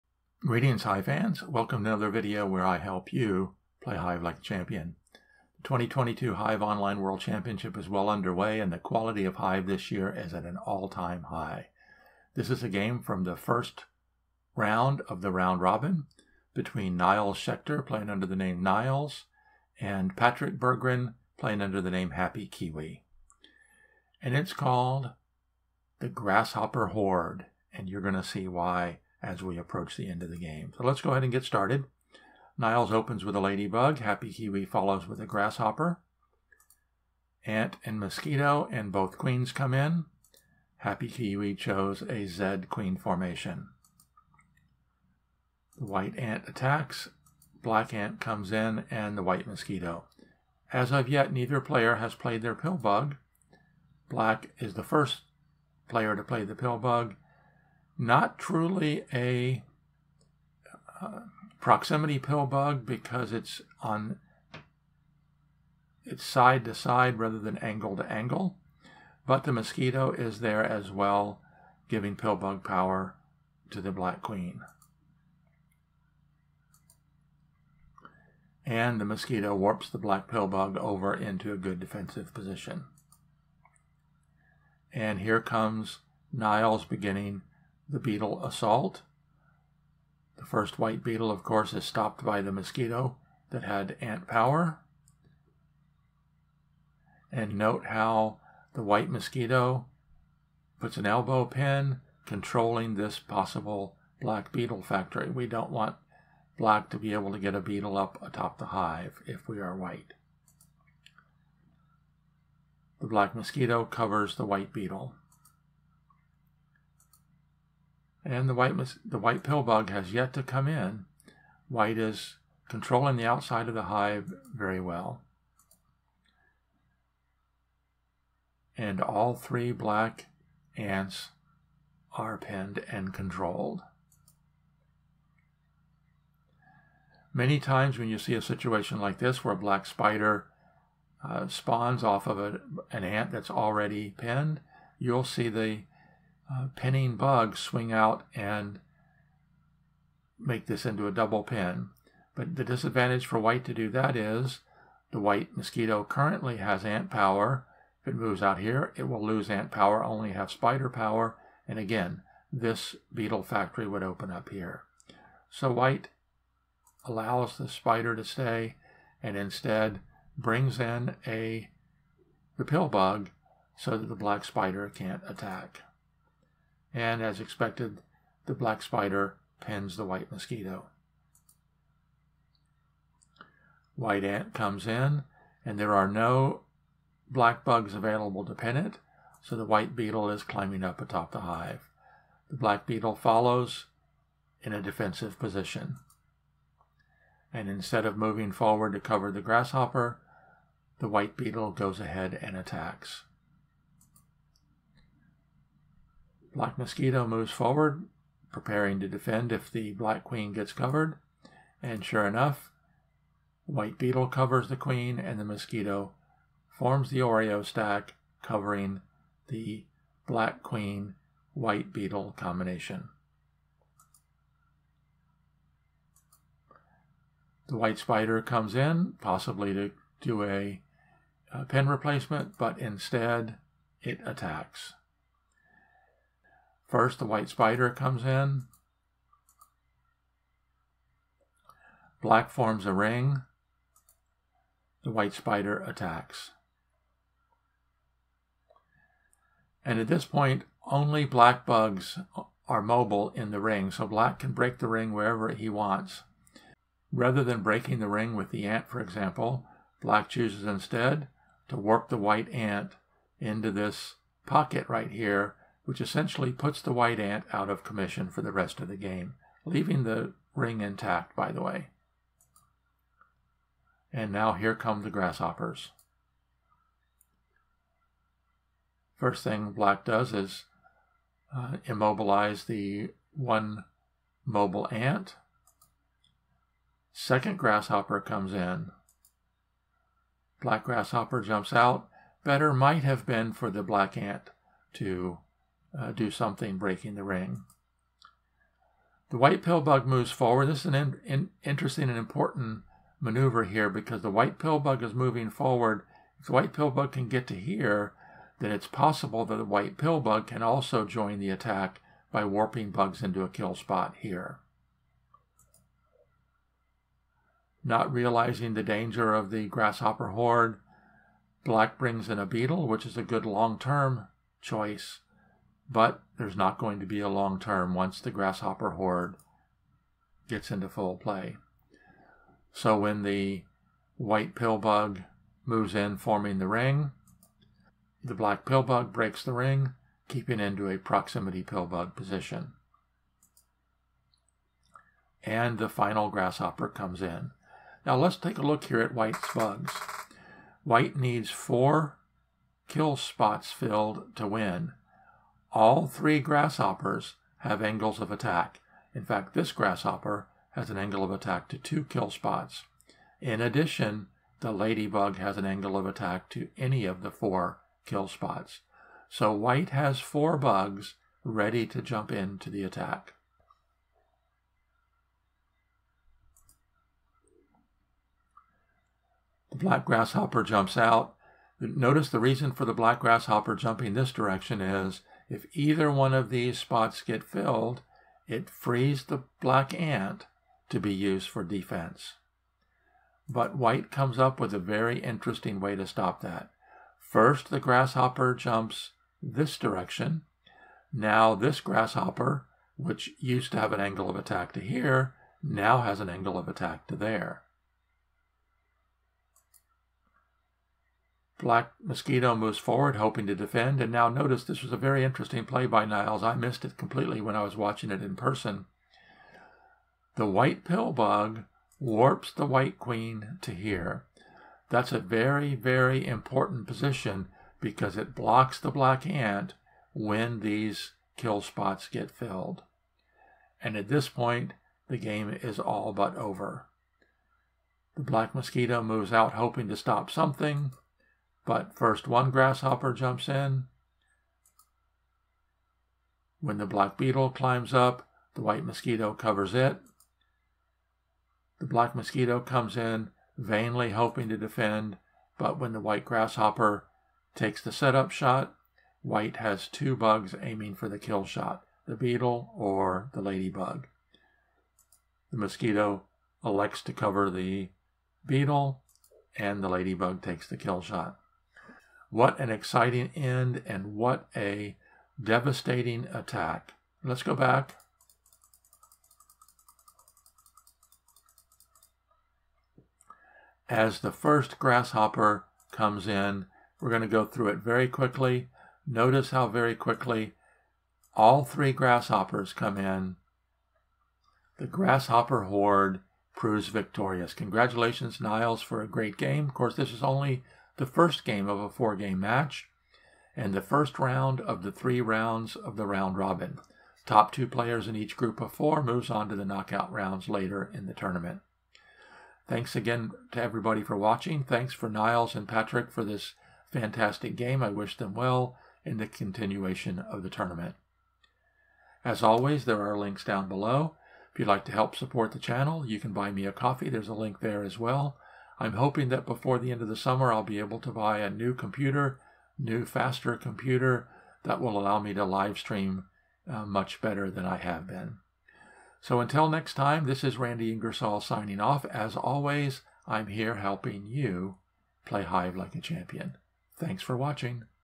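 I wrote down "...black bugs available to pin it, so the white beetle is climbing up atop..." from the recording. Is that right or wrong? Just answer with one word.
right.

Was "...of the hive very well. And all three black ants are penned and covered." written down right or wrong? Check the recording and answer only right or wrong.
wrong.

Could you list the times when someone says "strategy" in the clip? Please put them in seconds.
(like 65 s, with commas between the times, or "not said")
not said.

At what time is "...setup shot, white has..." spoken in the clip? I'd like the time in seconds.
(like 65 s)
457 s.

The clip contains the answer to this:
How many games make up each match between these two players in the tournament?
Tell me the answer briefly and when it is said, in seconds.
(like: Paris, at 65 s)
4, at 501 s.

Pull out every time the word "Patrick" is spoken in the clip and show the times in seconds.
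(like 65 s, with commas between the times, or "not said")
20 s, 515 s.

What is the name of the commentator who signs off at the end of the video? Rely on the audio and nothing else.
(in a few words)
Randy Ingersoll.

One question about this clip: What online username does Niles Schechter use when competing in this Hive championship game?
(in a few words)
neighlles.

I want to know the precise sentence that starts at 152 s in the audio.
But the disadvantage for white to do that is the white mosquito currently has ant power.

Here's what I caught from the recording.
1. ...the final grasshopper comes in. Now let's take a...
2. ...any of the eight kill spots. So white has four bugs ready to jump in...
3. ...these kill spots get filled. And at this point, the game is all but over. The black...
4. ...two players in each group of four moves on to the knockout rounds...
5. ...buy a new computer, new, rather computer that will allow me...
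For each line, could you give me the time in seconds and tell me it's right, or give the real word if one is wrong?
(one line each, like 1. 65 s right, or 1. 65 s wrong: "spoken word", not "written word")
1. 345 s right
2. 366 s wrong: "four", not "eight"
3. 430 s right
4. 507 s right
5. 531 s wrong: "faster", not "rather".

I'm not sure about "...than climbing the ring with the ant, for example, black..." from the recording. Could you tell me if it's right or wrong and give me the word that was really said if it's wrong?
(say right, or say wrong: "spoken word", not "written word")
wrong: "breaking", not "climbing".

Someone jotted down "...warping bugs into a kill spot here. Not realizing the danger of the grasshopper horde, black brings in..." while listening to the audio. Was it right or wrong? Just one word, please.
right.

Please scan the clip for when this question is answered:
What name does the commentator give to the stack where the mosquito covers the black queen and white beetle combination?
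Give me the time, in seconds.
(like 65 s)
217 s.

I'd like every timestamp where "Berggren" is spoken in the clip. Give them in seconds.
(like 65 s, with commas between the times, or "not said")
20 s.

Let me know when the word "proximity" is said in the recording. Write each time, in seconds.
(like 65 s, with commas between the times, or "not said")
61 s, 340 s.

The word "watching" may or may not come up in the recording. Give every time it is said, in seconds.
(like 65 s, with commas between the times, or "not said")
417 s, 514 s, 547 s.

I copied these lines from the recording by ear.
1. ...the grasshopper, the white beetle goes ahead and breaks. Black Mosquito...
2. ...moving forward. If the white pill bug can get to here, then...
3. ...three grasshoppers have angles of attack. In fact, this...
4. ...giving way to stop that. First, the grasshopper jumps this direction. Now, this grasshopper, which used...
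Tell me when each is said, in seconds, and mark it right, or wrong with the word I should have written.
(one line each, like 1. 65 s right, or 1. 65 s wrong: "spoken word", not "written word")
1. 199 s wrong: "attacks", not "breaks"
2. 305 s right
3. 356 s right
4. 395 s wrong: "interesting", not "giving".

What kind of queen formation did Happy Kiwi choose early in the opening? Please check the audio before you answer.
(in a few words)
Z queen formation.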